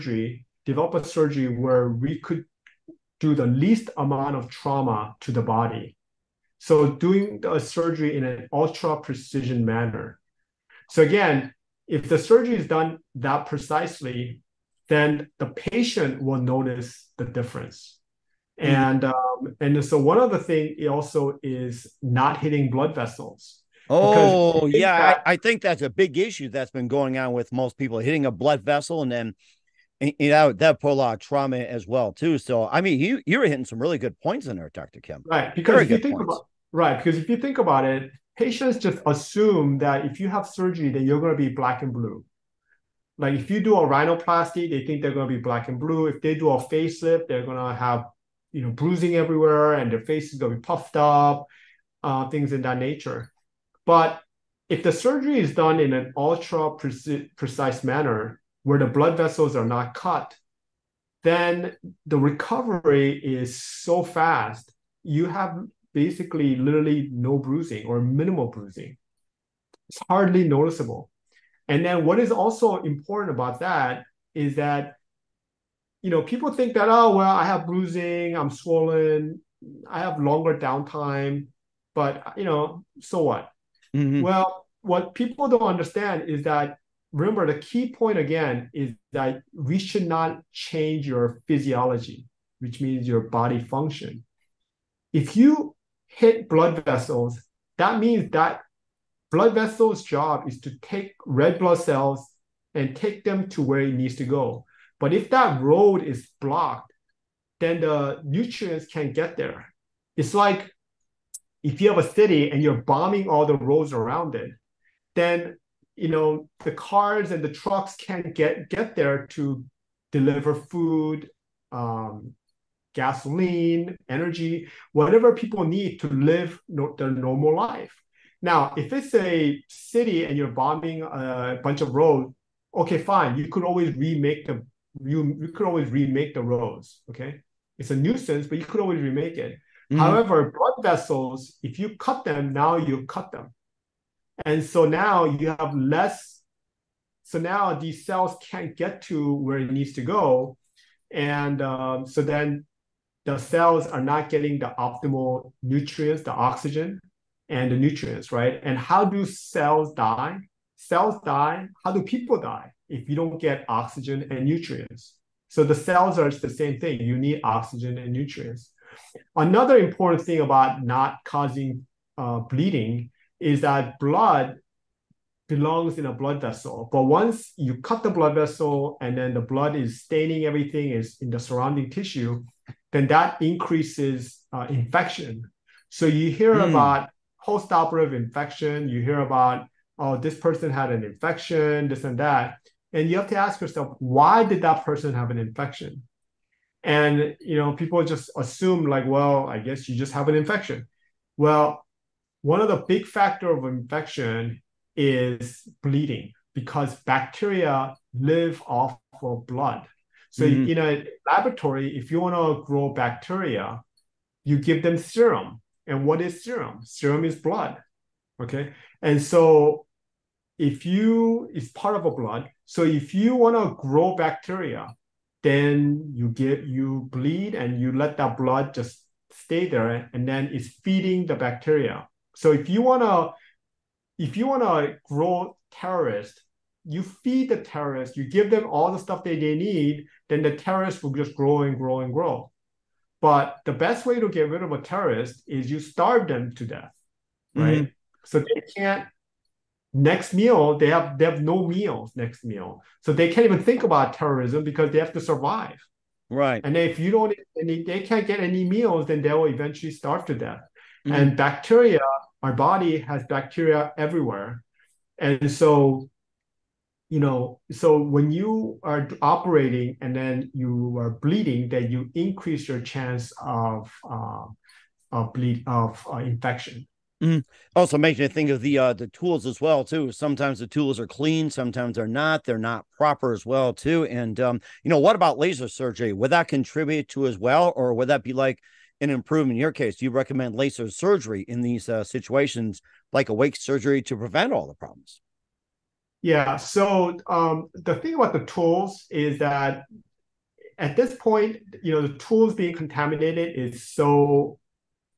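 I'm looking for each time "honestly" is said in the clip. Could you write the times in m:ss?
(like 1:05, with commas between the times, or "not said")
not said.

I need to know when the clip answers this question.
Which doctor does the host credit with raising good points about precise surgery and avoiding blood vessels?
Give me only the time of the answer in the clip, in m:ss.
0:34.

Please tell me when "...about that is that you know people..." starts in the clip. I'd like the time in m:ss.
1:13.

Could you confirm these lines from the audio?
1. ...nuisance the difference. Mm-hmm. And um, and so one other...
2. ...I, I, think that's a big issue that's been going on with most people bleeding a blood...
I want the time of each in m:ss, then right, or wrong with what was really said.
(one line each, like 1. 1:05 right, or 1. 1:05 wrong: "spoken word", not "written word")
1. 0:16 wrong: "notice", not "nuisance"
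2. 0:25 wrong: "hitting", not "bleeding".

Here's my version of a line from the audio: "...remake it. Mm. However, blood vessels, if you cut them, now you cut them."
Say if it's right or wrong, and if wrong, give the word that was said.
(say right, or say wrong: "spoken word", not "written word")
right.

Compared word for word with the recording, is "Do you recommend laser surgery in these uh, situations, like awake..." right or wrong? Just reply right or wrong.
right.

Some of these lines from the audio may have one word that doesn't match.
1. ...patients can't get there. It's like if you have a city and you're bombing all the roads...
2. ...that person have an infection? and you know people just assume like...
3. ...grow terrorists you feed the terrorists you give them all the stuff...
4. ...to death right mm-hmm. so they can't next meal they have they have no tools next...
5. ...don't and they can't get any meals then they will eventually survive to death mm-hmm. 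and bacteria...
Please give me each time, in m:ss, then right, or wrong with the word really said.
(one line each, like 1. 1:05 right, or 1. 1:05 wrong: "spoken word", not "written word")
1. 1:48 wrong: "nutrients", not "patients"
2. 3:14 right
3. 3:55 right
4. 4:06 wrong: "meals", not "tools"
5. 4:17 wrong: "starve", not "survive".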